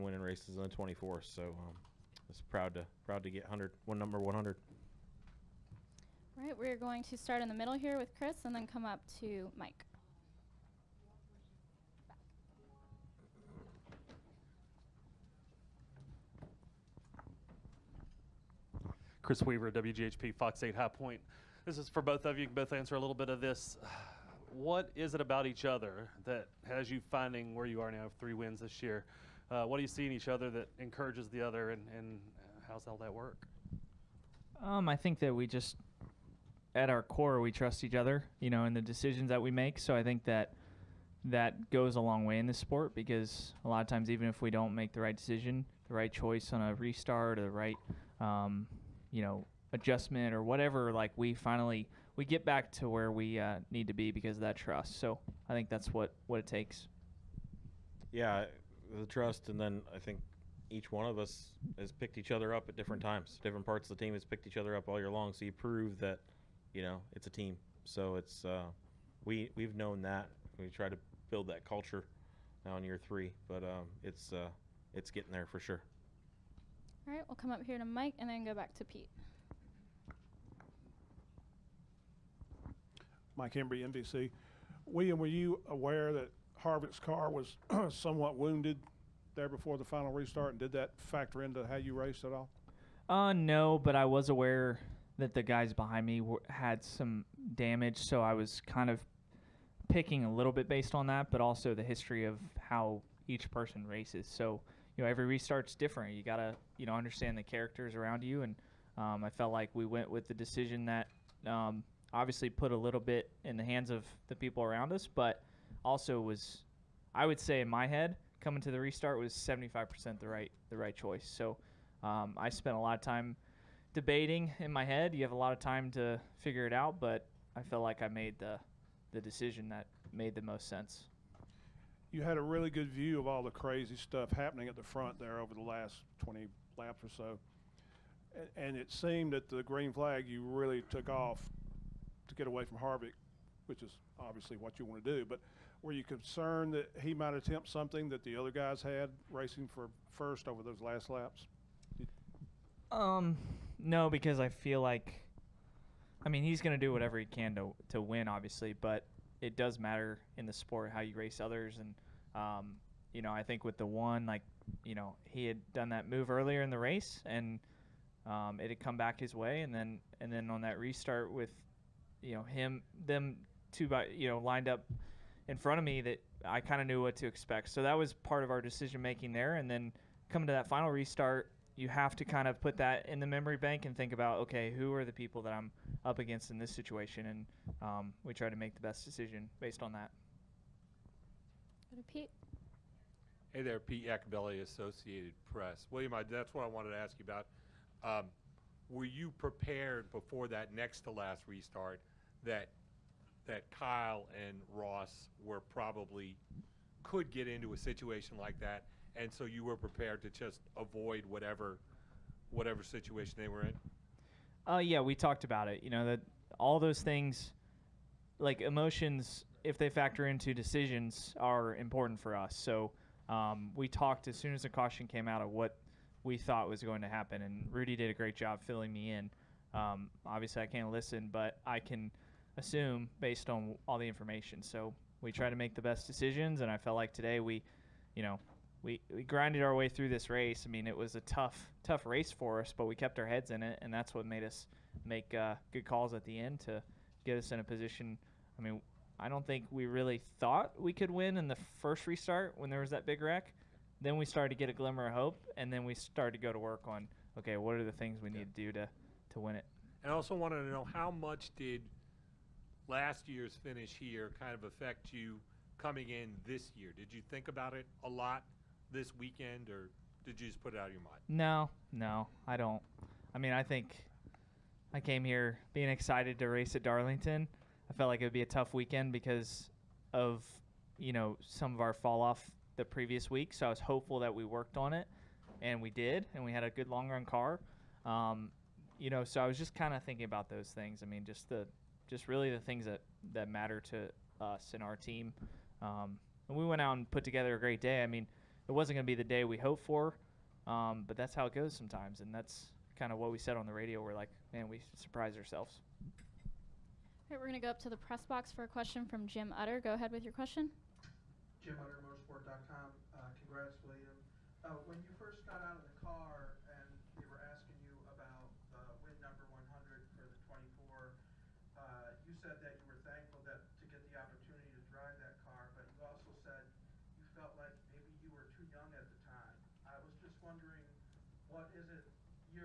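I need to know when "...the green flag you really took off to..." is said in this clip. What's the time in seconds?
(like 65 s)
139 s.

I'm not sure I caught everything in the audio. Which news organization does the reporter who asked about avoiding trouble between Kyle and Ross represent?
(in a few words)
Associated Press.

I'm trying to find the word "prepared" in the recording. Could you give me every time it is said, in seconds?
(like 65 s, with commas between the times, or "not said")
199 s, 209 s.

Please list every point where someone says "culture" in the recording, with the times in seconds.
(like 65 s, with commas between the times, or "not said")
71 s.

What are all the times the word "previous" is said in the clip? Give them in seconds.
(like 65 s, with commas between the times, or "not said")
282 s.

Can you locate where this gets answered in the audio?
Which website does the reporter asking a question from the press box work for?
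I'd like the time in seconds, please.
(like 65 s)
312 s.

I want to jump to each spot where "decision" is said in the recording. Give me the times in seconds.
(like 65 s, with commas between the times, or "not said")
38 s, 45 s, 110 s, 129 s, 178 s, 189 s, 220 s, 236 s.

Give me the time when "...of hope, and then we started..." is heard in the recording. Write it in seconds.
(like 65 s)
255 s.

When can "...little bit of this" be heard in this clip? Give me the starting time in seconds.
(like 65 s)
22 s.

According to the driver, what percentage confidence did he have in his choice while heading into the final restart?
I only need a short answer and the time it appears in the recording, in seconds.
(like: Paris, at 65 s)
75%, at 119 s.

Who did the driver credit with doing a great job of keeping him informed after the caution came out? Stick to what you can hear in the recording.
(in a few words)
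Rudy.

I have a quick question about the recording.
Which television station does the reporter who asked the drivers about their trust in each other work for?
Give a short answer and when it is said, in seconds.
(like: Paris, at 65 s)
WGHP, at 19 s.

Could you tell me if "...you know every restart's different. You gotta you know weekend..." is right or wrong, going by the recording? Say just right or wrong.
wrong.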